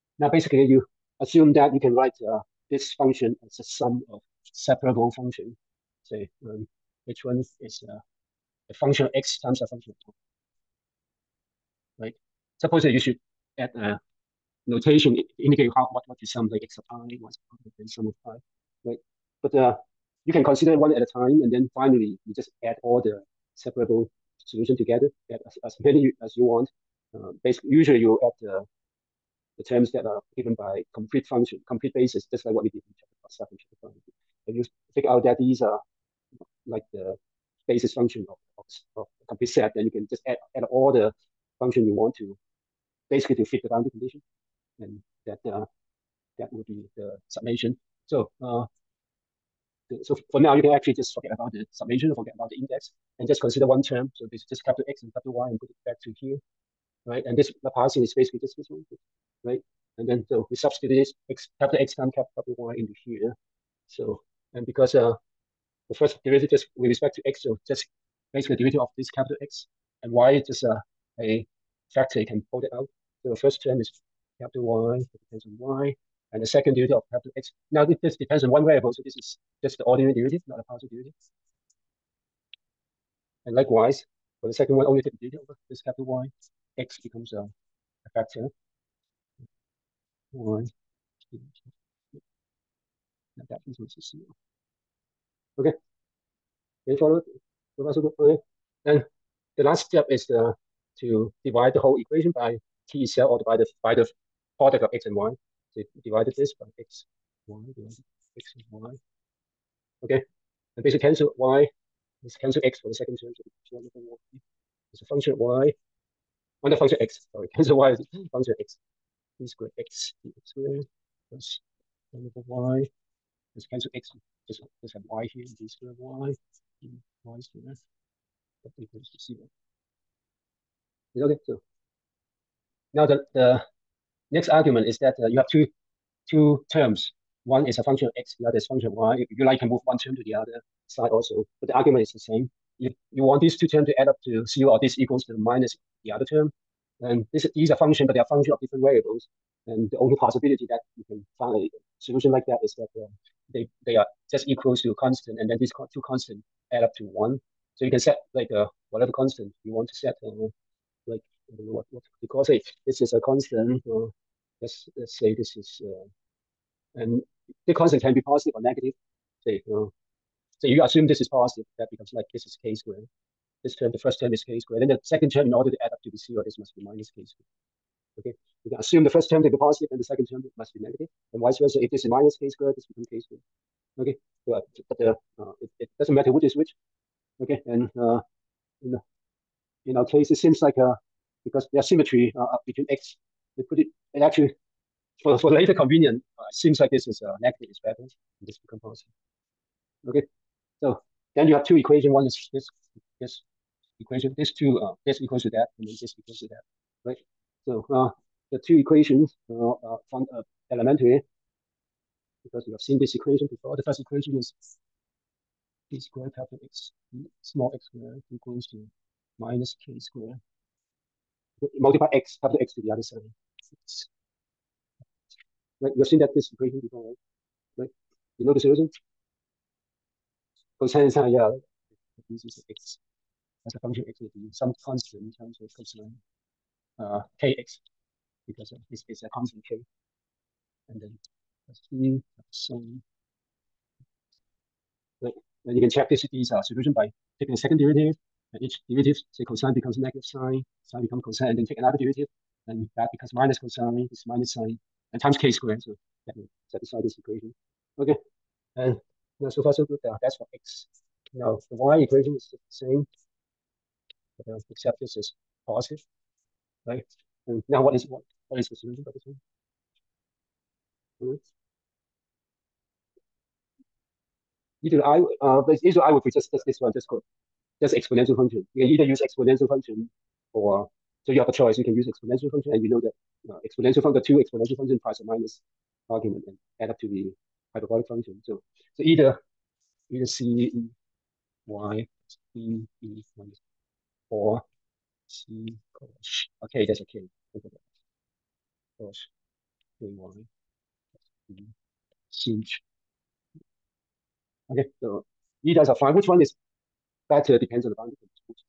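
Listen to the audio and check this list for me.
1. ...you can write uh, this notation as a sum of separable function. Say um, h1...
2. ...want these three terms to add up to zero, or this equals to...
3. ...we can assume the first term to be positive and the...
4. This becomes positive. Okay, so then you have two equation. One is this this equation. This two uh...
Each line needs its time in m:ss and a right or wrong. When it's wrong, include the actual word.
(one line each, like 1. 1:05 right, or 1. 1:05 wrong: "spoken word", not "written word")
1. 0:01 wrong: "function", not "notation"
2. 2:23 wrong: "two", not "three"
3. 2:58 right
4. 3:18 right.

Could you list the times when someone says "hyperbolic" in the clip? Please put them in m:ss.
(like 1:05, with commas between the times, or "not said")
4:47.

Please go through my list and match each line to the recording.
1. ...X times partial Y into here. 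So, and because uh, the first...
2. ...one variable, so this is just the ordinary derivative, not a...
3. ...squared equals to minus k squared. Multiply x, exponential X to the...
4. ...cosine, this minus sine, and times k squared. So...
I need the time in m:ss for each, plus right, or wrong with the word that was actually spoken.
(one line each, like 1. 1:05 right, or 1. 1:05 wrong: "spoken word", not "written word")
1. 1:01 wrong: "capital", not "partial"
2. 1:18 right
3. 3:37 wrong: "capital", not "exponential"
4. 4:13 right.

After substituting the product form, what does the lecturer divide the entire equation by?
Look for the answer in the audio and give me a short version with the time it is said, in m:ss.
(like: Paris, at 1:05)
the product of X and Y, at 1:44.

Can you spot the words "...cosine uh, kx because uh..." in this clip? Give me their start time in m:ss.
3:55.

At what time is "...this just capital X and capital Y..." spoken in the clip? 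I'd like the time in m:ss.
0:54.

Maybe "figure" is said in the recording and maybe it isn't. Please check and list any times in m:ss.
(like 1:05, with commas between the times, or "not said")
0:34.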